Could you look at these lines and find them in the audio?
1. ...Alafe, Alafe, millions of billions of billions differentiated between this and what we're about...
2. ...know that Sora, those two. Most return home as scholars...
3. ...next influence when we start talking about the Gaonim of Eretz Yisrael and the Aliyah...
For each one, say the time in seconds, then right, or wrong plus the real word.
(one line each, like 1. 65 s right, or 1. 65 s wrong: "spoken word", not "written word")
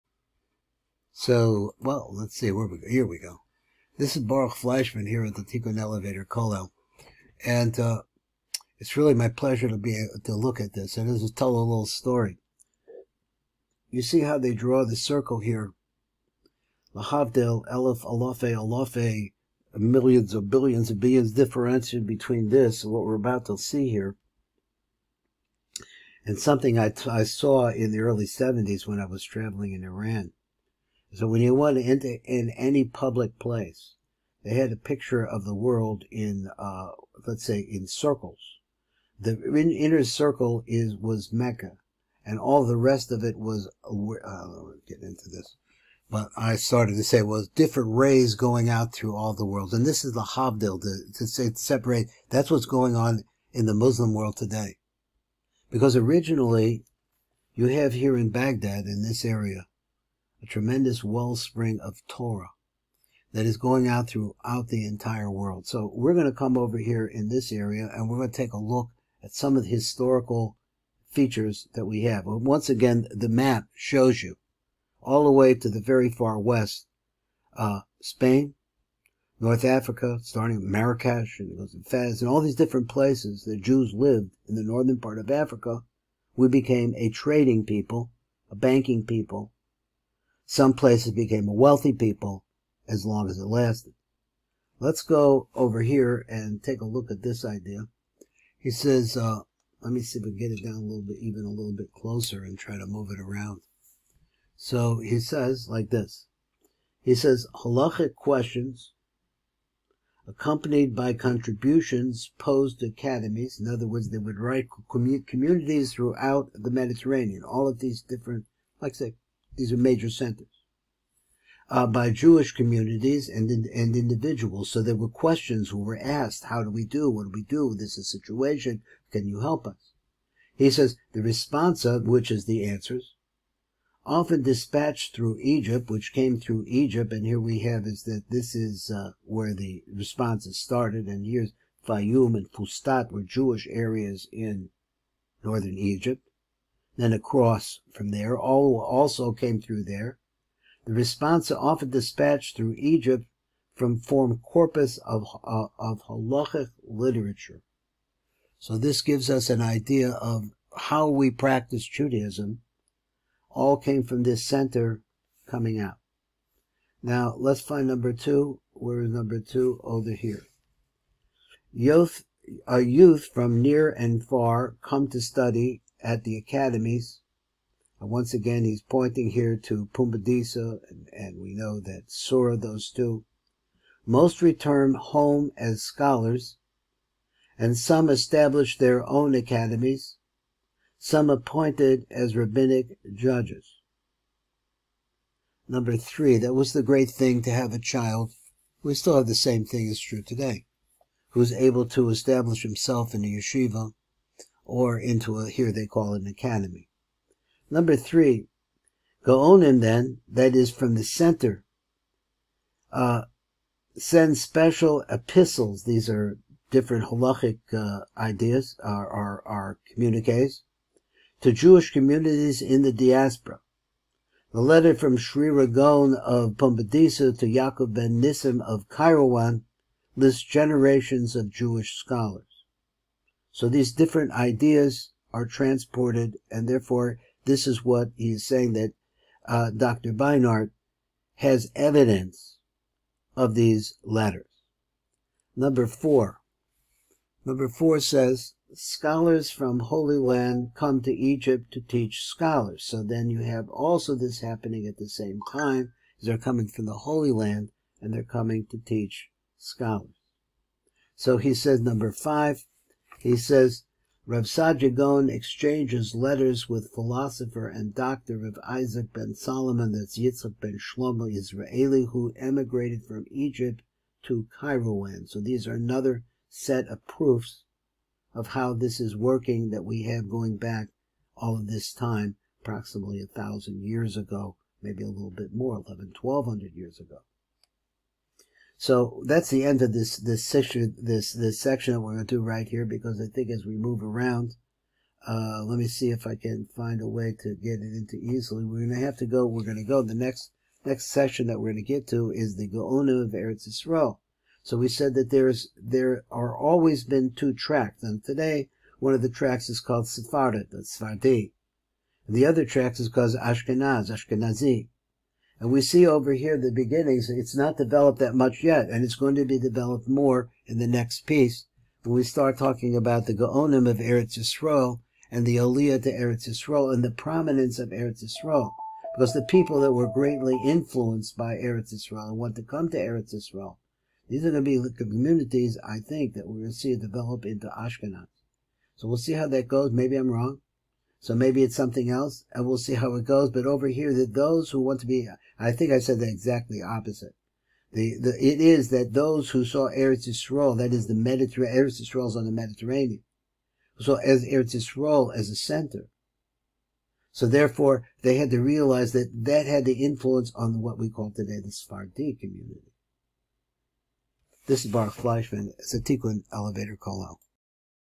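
1. 18 s right
2. 181 s right
3. 320 s wrong: "piece", not "influence".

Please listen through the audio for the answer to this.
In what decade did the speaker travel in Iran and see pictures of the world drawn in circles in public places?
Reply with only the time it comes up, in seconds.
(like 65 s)
27 s.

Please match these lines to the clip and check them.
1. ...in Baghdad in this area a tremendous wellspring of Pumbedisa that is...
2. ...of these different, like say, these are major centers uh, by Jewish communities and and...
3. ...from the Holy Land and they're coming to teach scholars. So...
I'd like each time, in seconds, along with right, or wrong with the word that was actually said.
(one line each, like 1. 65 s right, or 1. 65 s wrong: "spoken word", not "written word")
1. 58 s wrong: "Torah", not "Pumbedisa"
2. 117 s right
3. 256 s right.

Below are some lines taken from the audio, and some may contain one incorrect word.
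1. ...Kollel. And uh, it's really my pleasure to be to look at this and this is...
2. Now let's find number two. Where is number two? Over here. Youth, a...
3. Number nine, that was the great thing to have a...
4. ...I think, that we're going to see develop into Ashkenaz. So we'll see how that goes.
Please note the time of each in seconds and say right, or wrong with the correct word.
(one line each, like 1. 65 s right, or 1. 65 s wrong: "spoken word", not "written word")
1. 6 s right
2. 167 s right
3. 195 s wrong: "three", not "nine"
4. 335 s right.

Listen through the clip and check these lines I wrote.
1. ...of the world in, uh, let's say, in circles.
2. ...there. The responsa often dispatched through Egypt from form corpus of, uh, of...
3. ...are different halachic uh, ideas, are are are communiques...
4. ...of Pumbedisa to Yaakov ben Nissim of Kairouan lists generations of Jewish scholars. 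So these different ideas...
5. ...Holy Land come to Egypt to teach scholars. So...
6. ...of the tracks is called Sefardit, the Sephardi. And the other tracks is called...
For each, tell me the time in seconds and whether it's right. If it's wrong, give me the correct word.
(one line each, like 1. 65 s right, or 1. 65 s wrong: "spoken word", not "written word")
1. 35 s right
2. 149 s right
3. 216 s right
4. 226 s right
5. 249 s right
6. 309 s right.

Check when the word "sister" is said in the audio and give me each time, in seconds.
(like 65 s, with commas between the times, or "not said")
not said.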